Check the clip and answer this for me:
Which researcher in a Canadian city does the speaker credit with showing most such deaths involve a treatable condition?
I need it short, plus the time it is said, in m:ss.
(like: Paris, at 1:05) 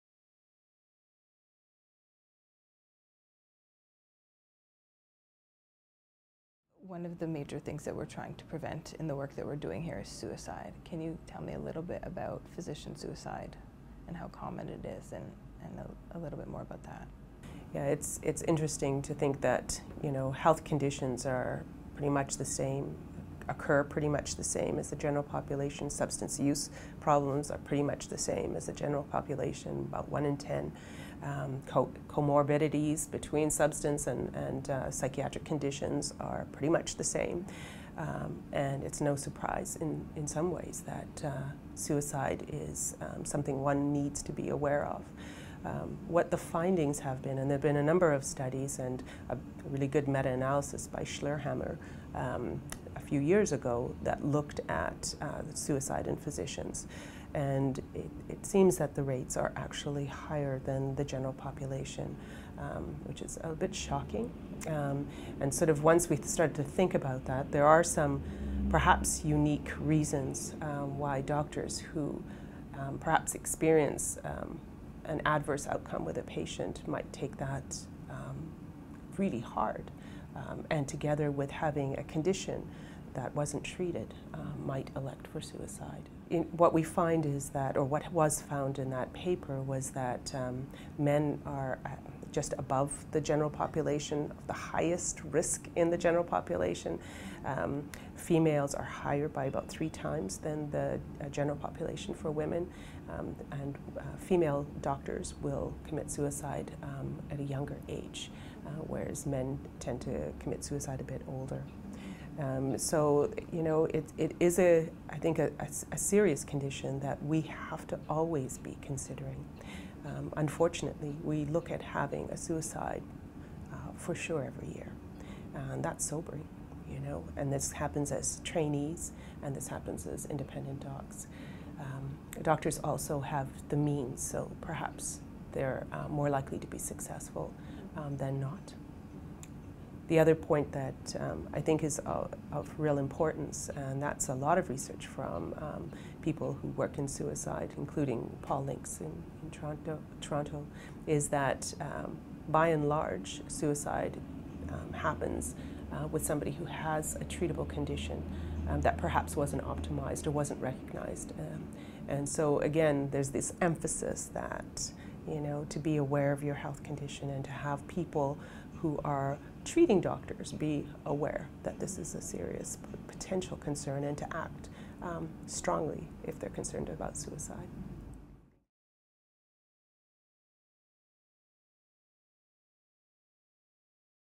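Paul Links, at 2:28.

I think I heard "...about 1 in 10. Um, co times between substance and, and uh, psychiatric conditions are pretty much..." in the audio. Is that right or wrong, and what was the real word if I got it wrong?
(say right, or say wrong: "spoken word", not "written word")
wrong: "comorbidities", not "times".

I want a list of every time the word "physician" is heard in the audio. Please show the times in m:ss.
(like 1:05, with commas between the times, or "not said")
0:12, 0:56.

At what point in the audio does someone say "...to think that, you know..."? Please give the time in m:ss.
0:19.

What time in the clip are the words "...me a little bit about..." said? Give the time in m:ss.
0:11.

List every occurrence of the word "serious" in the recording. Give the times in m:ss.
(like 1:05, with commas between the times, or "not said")
1:55, 2:52.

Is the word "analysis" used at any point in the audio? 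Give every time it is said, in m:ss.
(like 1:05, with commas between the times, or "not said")
0:50.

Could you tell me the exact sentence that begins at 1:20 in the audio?
Um, and together with having a condition that wasn't treated uh, might elect for suicide.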